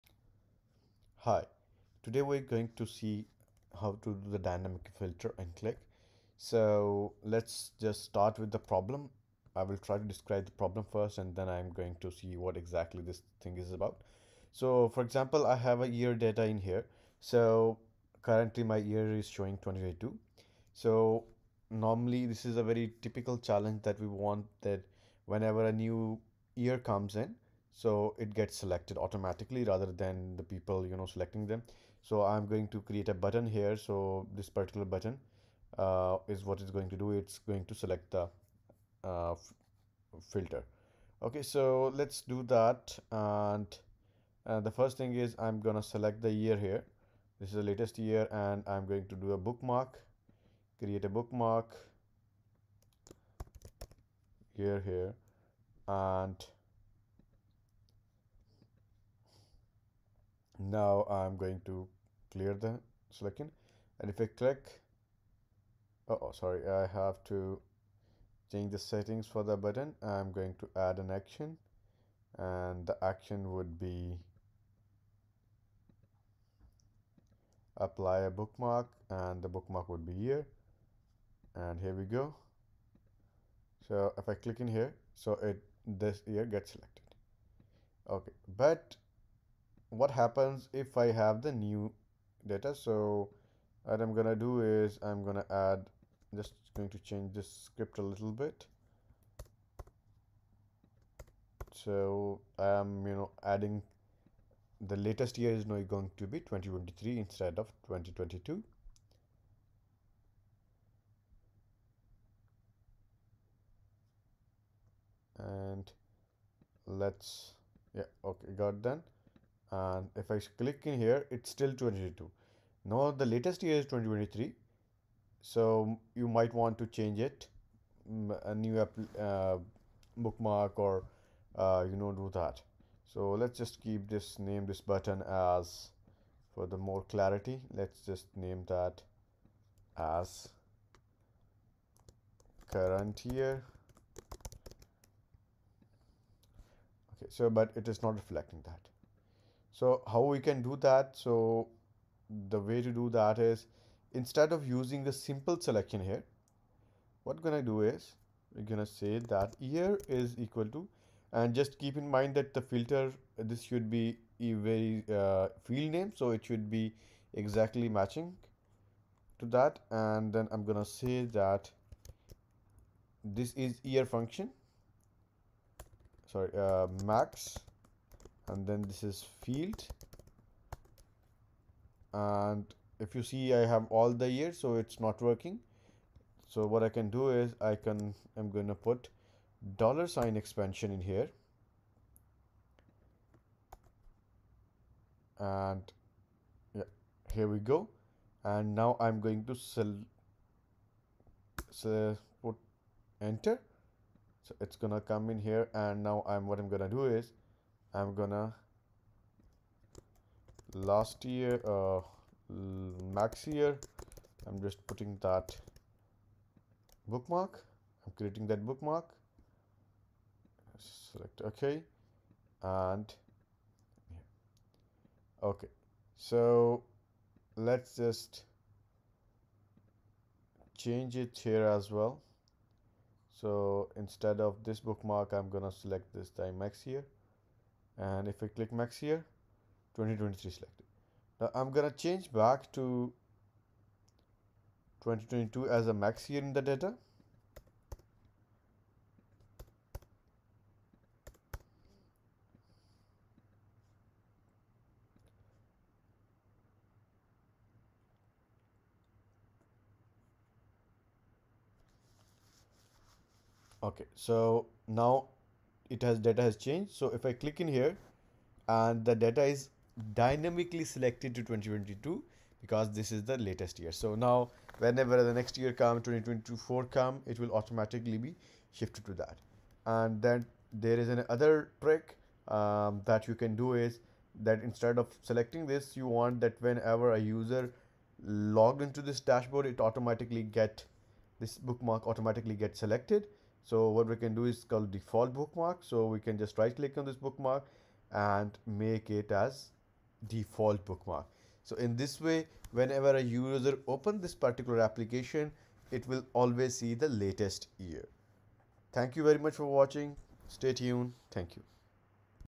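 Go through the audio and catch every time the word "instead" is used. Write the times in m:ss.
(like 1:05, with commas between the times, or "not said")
1:47, 2:34, 3:53, 4:44.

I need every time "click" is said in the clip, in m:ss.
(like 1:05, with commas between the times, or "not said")
1:04, 1:24, 2:00, 3:58, 4:27, 4:56.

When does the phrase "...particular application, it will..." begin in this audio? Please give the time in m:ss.
5:04.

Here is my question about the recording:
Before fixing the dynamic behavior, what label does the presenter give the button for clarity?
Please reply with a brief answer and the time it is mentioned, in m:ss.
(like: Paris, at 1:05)
current year, at 2:22.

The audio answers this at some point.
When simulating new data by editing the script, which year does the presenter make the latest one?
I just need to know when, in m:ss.
1:46.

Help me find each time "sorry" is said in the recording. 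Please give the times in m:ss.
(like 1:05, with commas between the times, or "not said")
1:06, 2:56.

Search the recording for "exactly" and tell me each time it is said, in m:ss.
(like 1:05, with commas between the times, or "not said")
0:12, 2:47.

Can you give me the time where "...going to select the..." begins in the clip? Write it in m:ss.
0:37.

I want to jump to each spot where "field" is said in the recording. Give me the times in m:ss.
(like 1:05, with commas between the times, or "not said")
2:45, 2:59.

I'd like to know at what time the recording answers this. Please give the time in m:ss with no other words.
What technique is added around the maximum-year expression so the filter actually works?
3:09.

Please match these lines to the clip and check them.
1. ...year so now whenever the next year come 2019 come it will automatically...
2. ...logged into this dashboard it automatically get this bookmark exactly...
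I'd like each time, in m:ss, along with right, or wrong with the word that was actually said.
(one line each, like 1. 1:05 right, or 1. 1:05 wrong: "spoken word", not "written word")
1. 4:33 wrong: "2024", not "2019"
2. 4:48 wrong: "automatically", not "exactly".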